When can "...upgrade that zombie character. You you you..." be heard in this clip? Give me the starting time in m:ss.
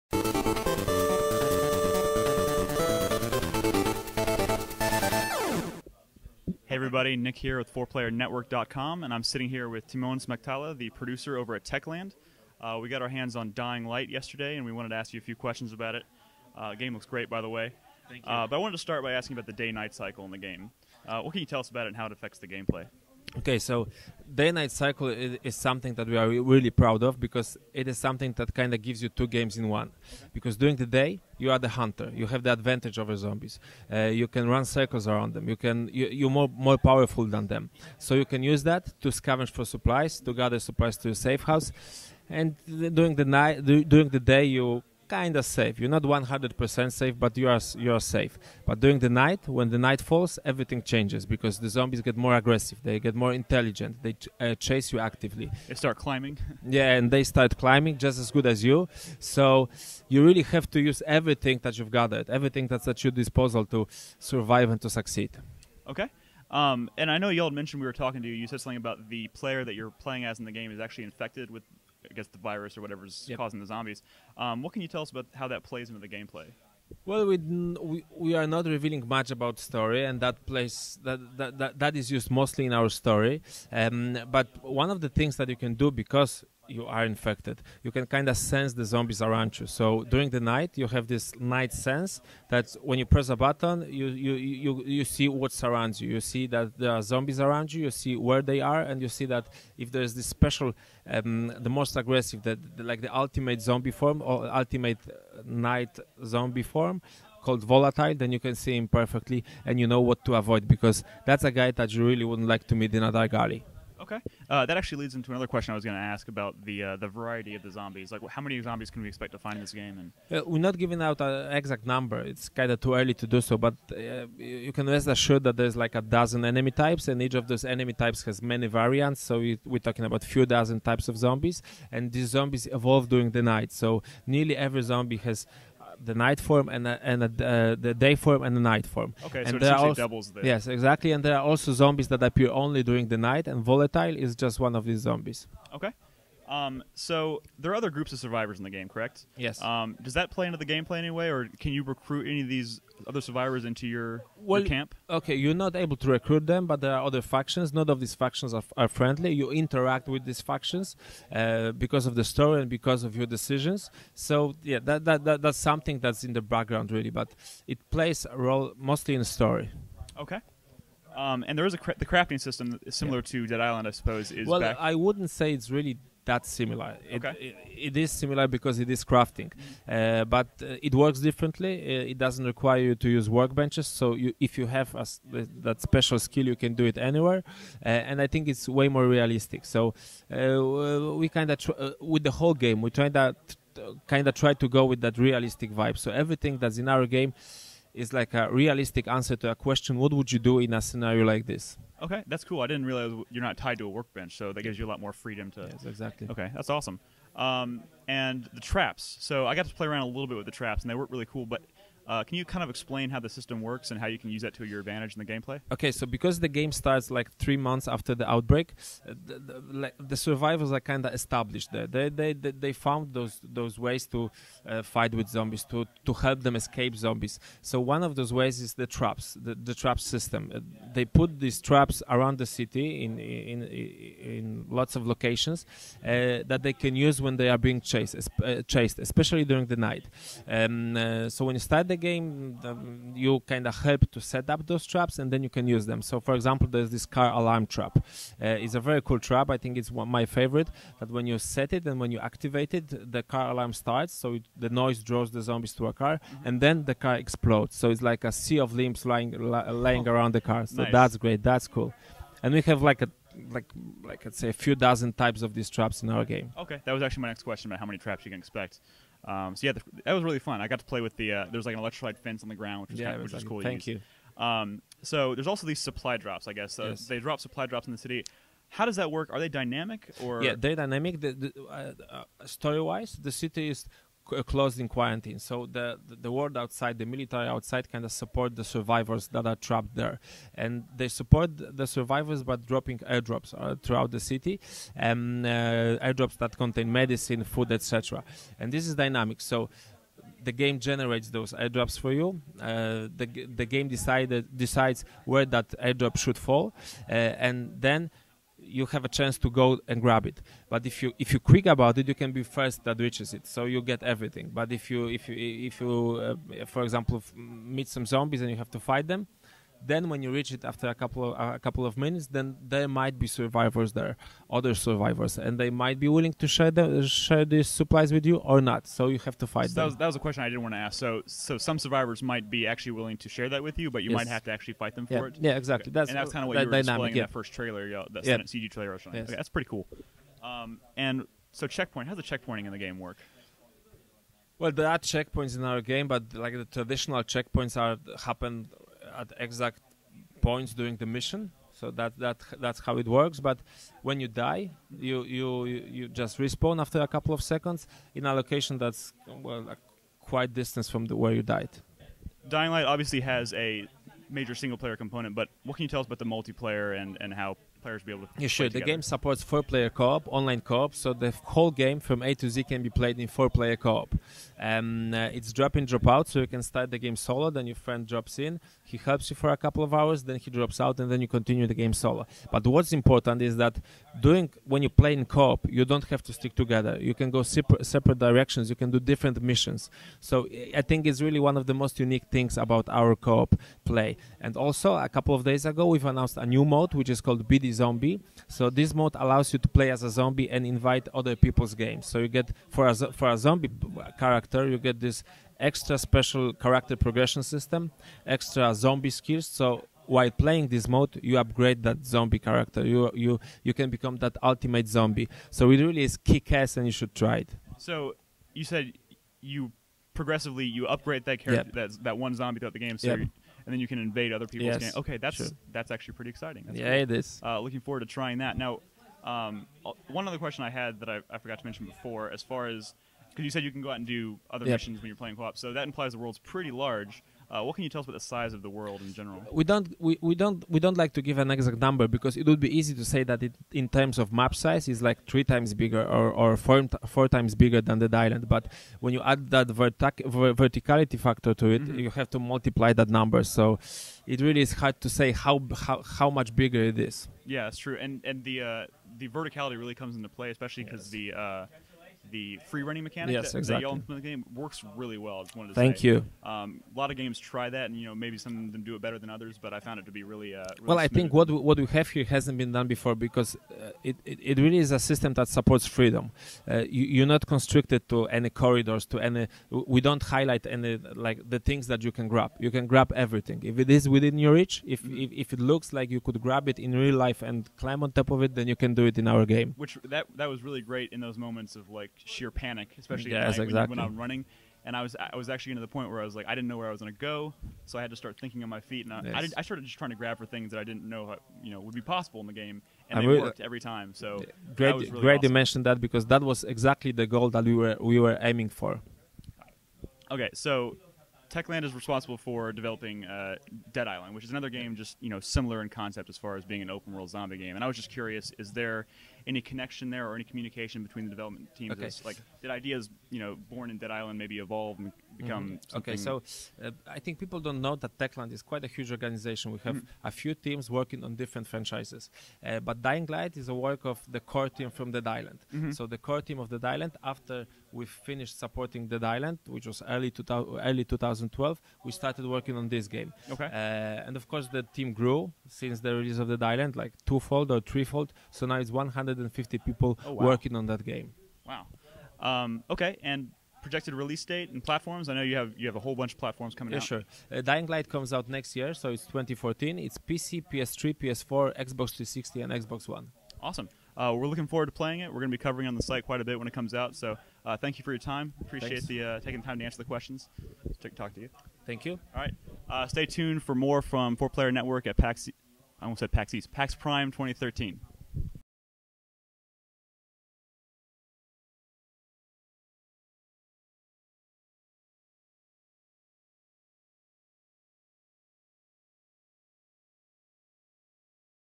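6:51.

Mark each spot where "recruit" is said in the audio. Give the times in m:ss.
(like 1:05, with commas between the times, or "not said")
2:31, 2:36.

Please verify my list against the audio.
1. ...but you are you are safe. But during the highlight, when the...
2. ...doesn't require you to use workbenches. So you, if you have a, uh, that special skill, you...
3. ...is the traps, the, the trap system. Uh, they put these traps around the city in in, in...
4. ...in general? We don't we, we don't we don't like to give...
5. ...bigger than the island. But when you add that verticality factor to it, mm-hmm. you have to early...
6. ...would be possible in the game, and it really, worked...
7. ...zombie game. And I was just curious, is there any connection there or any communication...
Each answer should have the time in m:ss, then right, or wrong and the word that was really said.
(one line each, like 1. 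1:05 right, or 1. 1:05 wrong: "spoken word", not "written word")
1. 0:47 wrong: "night", not "highlight"
2. 3:02 right
3. 3:48 right
4. 7:19 right
5. 7:27 wrong: "multiply", not "early"
6. 8:21 right
7. 8:37 right.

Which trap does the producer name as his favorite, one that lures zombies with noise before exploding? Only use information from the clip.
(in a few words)
Car alarm trap.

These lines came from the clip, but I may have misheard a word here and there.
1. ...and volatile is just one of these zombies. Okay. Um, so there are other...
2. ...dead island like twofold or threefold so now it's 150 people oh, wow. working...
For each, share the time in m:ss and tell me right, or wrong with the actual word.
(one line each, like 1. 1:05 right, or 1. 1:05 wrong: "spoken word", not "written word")
1. 2:23 right
2. 9:06 right.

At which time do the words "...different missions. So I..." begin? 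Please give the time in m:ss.
6:28.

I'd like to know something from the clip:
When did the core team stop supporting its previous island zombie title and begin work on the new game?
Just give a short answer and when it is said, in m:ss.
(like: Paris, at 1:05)
Early 2012, at 9:00.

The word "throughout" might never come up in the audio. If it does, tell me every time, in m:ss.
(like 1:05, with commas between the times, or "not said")
4:53, 7:02.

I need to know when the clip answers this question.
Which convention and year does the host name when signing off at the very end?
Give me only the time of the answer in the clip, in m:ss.
9:36.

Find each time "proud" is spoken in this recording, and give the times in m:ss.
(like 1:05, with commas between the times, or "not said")
0:26.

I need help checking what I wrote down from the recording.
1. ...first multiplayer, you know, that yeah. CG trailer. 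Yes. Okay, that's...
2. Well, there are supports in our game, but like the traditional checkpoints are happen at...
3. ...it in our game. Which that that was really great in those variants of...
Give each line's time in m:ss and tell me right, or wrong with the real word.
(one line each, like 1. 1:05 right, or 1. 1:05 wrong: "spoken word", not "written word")
1. 5:37 wrong: "trailer", not "multiplayer"
2. 5:44 wrong: "checkpoints", not "supports"
3. 8:09 wrong: "moments", not "variants".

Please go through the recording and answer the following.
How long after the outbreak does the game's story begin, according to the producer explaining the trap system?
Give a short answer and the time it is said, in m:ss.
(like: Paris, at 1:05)
Three months, at 3:37.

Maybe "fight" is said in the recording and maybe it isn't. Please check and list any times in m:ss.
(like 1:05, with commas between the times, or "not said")
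3:44, 5:18, 5:29, 5:34.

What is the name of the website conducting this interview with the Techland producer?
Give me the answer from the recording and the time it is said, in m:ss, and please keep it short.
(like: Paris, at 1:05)
FourPlayerNetwork.com, at 0:07.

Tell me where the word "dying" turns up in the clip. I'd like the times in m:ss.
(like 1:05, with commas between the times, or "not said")
0:13, 6:02, 8:53, 9:17.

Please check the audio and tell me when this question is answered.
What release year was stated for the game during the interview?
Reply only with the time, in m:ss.
9:19.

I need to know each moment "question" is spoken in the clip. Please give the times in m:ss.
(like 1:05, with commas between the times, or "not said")
0:15, 1:55, 3:19, 4:27, 5:30, 7:10, 9:30.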